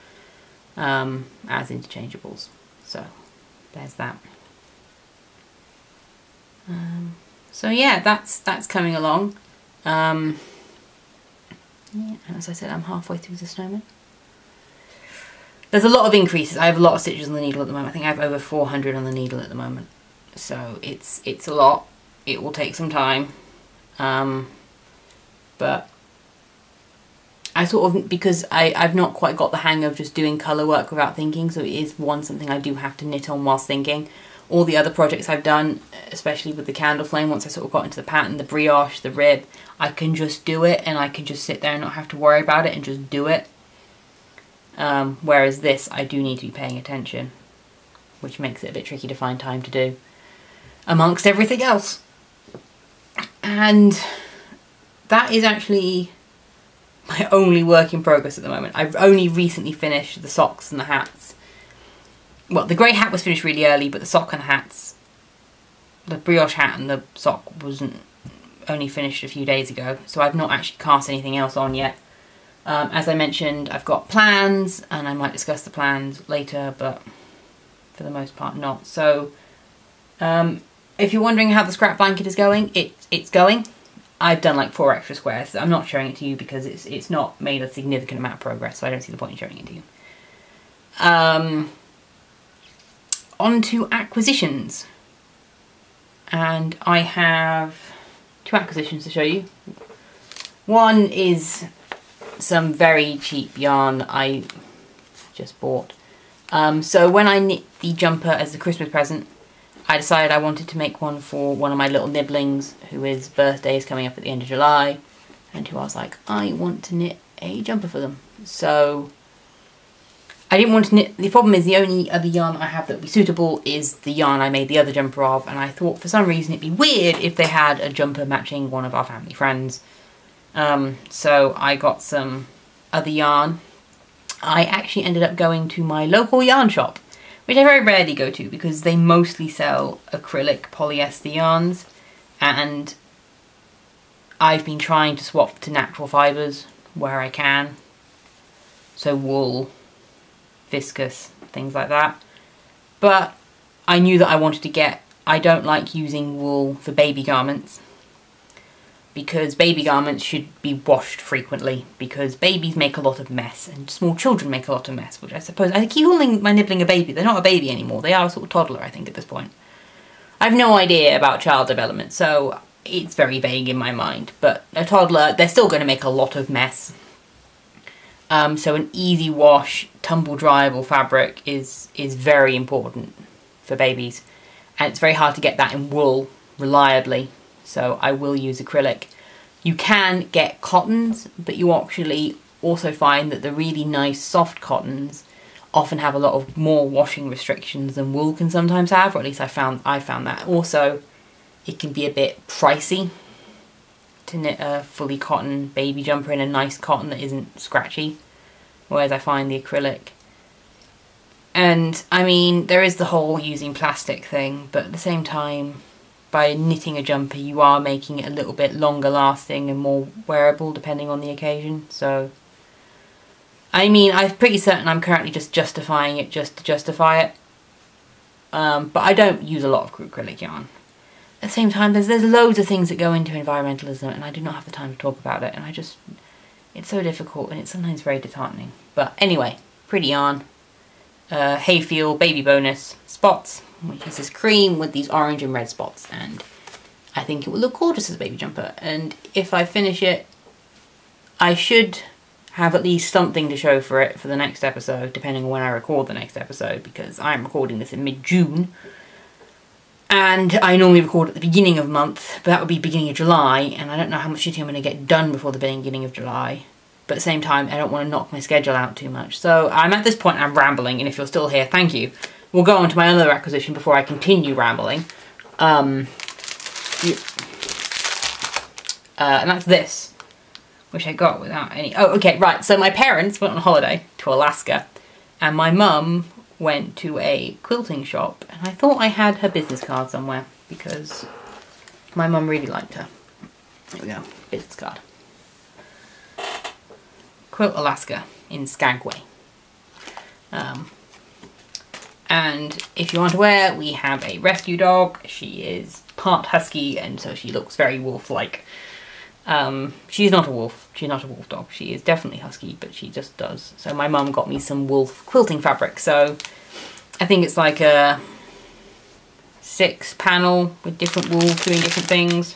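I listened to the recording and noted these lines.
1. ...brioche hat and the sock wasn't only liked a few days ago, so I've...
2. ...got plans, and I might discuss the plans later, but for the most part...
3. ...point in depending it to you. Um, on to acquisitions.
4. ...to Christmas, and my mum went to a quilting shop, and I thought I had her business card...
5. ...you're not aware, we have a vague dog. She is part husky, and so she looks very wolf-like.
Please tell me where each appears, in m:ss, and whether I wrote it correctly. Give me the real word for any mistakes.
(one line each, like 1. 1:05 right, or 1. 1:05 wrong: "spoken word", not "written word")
1. 1:06 wrong: "finished", not "liked"
2. 1:13 right
3. 1:29 wrong: "showing", not "depending"
4. 4:44 wrong: "Alaska", not "Christmas"
5. 5:03 wrong: "rescue", not "vague".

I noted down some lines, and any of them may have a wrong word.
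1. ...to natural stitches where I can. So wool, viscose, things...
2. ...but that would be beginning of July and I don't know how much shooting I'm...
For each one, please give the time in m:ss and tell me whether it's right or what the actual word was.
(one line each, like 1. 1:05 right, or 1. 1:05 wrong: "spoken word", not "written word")
1. 2:25 wrong: "fibres", not "stitches"
2. 4:22 right.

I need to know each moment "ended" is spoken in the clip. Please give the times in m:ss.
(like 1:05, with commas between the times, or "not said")
2:15.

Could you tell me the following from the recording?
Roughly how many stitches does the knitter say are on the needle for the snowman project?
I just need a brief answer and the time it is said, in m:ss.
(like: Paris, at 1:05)
over 400, at 0:18.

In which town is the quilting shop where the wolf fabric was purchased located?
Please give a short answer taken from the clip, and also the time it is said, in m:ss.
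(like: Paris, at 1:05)
Skagway, at 4:58.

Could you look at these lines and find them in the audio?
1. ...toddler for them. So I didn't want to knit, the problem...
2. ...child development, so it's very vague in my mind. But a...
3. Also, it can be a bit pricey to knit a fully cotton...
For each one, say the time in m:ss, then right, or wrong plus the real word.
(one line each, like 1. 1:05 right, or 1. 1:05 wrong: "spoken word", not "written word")
1. 1:57 wrong: "jumper", not "toddler"
2. 2:51 right
3. 3:20 right.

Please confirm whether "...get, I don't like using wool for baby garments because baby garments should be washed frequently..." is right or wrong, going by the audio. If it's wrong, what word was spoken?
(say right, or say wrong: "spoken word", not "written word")
right.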